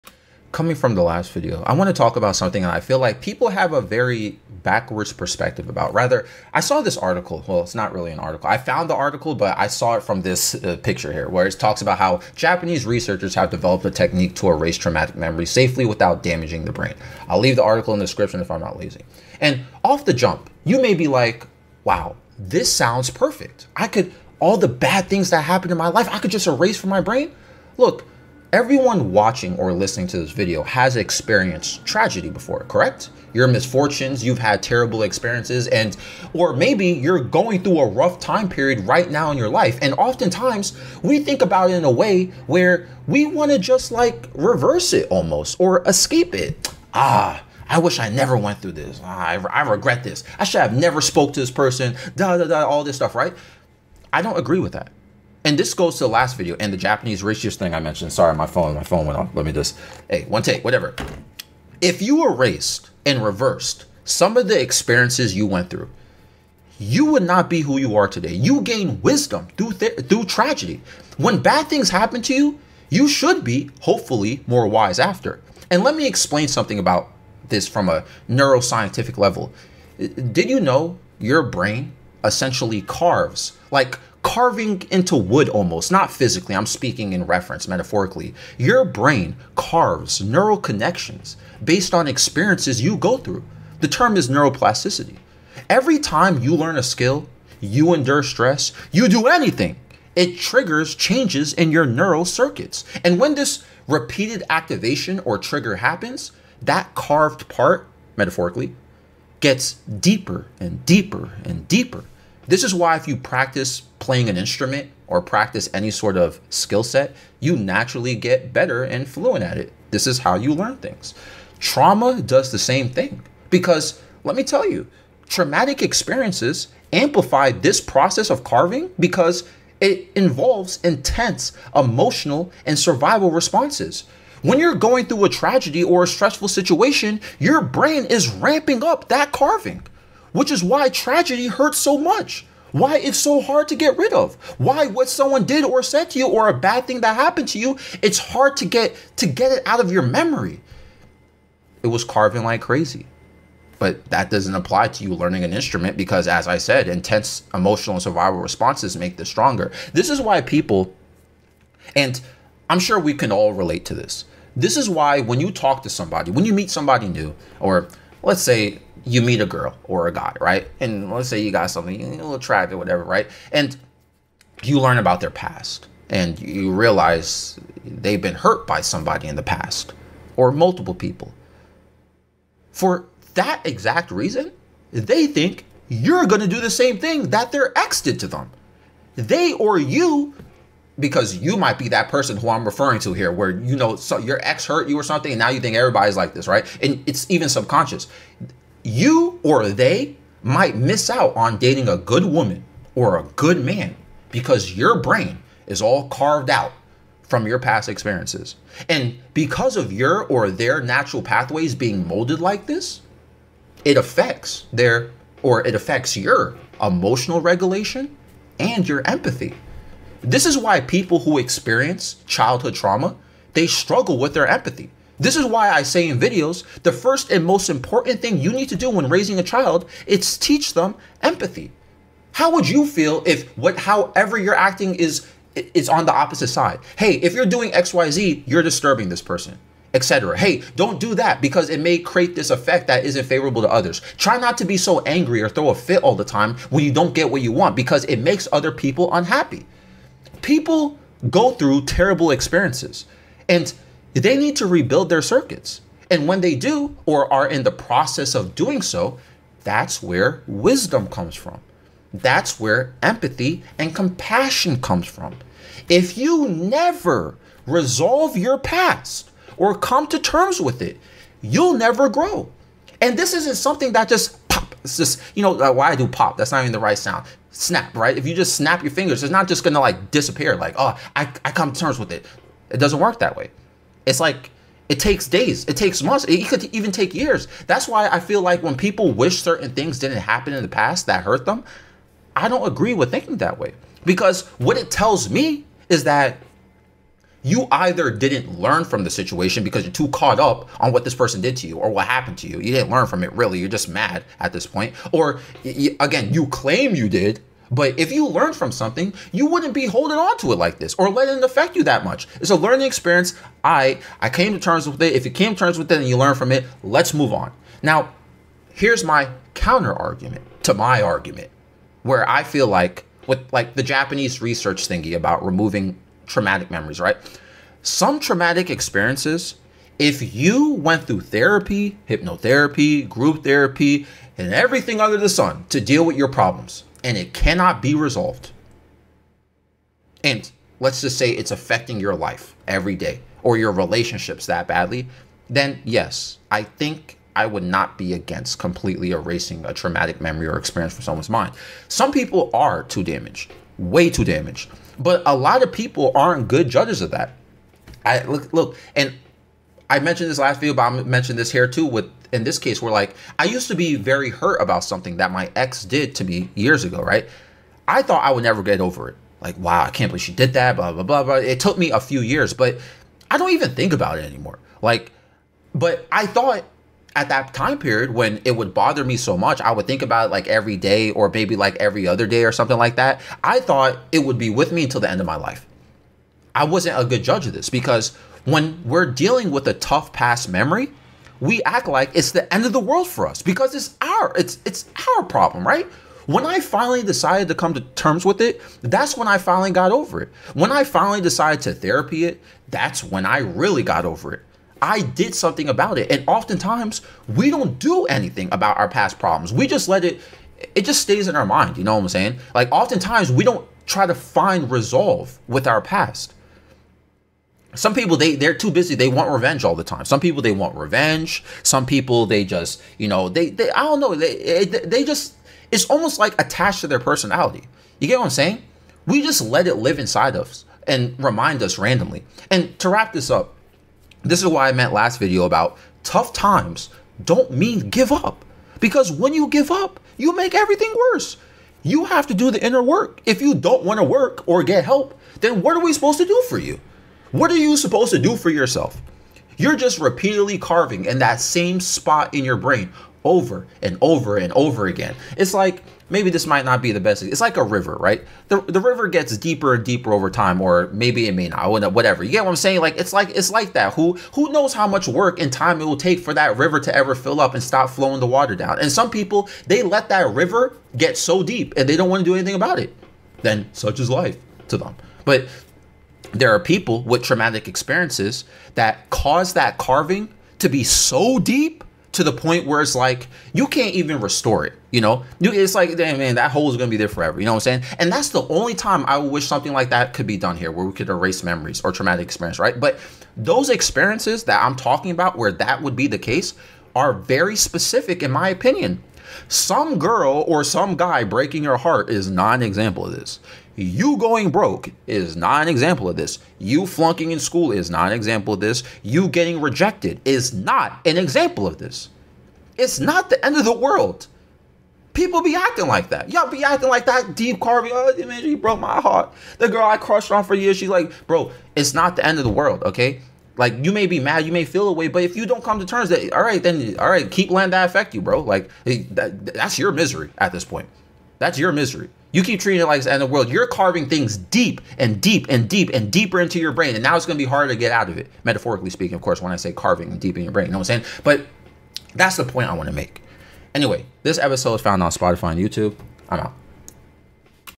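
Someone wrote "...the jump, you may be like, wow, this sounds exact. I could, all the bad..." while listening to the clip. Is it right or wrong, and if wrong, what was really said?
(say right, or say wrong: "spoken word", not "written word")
wrong: "perfect", not "exact".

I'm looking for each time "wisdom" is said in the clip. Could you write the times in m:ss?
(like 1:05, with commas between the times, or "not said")
1:09, 4:20.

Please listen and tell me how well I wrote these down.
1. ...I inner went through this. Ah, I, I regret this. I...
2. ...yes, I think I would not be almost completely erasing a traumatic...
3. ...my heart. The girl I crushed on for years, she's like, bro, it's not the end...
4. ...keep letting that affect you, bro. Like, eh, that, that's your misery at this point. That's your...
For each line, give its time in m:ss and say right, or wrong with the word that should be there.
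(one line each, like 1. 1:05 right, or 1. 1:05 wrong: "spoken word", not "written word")
1. 0:47 wrong: "never", not "inner"
2. 5:45 wrong: "against", not "almost"
3. 8:38 right
4. 8:47 right.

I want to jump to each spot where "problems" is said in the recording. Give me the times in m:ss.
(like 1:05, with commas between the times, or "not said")
5:36, 6:35, 6:49.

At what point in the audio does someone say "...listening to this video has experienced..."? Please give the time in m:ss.
0:29.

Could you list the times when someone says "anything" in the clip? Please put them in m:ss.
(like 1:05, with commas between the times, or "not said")
1:39, 6:48, 7:52.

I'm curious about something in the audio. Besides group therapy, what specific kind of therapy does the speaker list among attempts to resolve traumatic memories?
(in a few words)
Hypnotherapy.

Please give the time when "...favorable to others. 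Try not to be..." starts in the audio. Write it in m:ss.
4:03.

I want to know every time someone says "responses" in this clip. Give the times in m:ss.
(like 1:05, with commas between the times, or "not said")
2:13, 2:38.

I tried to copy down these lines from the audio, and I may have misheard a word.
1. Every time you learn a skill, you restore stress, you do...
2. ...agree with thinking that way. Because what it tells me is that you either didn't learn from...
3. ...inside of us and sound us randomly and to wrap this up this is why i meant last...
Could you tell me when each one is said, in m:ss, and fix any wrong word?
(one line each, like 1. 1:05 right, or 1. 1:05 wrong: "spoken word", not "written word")
1. 1:35 wrong: "endure", not "restore"
2. 4:52 right
3. 7:09 wrong: "remind", not "sound".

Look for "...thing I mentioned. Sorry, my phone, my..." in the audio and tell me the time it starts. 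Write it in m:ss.
0:57.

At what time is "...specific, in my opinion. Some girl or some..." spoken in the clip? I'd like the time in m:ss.
8:17.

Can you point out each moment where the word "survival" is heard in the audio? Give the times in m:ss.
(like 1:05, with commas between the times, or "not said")
2:12, 2:38.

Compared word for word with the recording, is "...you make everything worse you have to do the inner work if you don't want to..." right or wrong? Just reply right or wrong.
right.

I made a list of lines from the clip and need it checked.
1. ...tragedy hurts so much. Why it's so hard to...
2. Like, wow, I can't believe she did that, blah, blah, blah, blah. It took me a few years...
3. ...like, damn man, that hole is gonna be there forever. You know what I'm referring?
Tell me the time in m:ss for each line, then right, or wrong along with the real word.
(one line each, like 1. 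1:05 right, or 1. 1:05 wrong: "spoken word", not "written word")
1. 2:20 right
2. 6:09 right
3. 8:05 wrong: "saying", not "referring".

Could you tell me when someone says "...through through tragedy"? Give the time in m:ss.
1:09.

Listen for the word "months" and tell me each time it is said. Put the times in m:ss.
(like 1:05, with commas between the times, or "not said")
4:46.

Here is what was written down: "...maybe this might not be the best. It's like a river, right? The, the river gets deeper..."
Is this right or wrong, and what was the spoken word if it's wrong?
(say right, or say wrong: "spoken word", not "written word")
right.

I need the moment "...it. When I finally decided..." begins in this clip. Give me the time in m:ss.
6:40.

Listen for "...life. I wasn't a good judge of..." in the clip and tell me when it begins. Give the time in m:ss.
6:25.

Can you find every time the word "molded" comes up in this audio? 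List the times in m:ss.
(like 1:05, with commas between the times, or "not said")
3:32.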